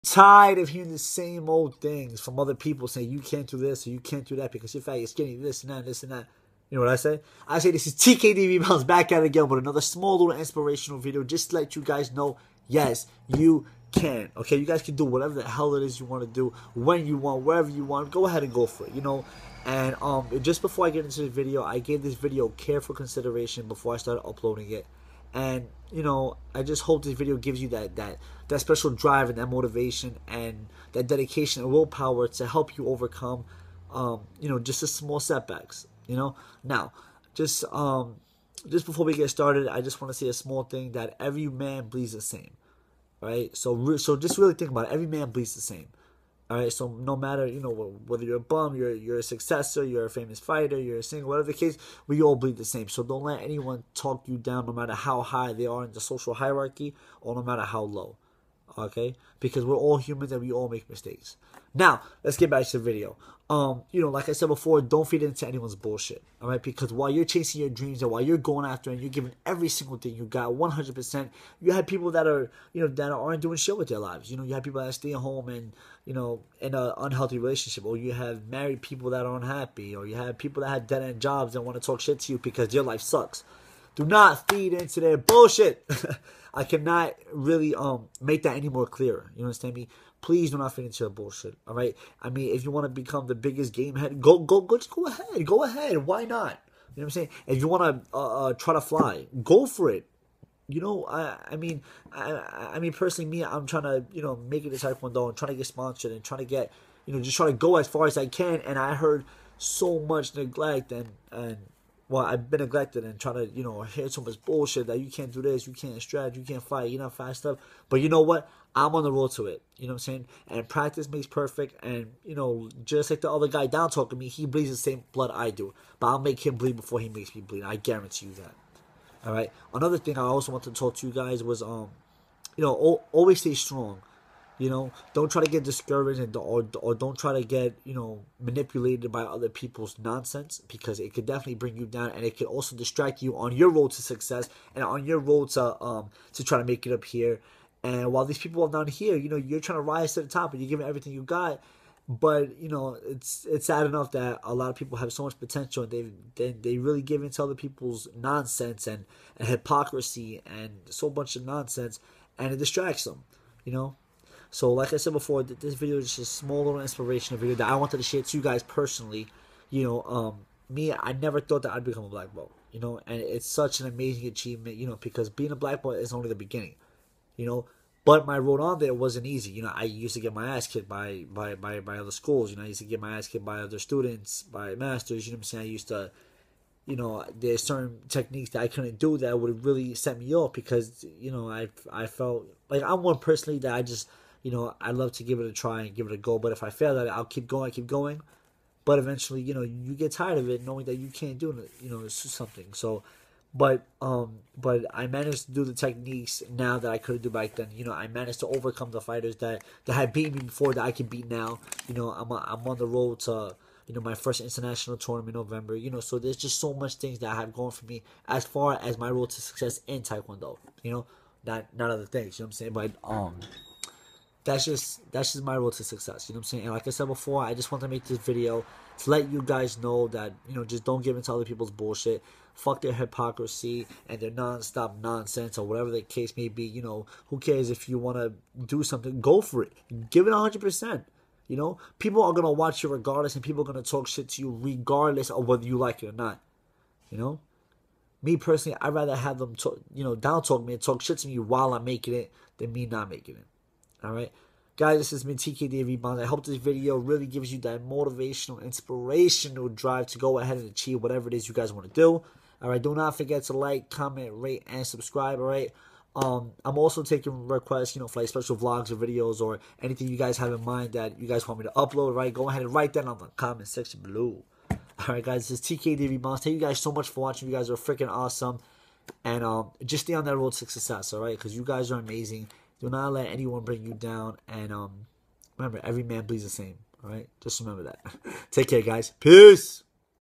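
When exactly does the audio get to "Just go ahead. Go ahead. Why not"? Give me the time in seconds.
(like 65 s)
94 s.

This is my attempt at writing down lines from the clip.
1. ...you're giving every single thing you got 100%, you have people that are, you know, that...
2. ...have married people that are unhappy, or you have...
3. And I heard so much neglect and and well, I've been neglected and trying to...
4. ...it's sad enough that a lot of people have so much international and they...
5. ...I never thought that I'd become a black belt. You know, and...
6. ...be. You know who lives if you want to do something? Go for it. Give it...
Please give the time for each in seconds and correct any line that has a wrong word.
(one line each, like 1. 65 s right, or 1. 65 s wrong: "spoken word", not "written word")
1. 69 s right
2. 78 s right
3. 108 s right
4. 153 s wrong: "potential", not "international"
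5. 170 s right
6. 236 s wrong: "cares", not "lives".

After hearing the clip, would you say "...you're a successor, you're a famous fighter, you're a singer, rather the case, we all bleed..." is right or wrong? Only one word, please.
wrong.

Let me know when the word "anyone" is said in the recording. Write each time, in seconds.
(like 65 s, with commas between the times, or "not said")
53 s, 65 s, 283 s.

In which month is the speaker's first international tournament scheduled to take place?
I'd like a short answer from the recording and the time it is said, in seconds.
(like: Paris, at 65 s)
November, at 215 s.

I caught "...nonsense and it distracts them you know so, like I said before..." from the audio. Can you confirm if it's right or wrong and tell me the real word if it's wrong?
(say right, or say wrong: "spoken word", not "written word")
right.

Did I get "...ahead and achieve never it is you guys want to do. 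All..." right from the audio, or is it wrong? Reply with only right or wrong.
wrong.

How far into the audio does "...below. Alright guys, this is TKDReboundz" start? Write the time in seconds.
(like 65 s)
274 s.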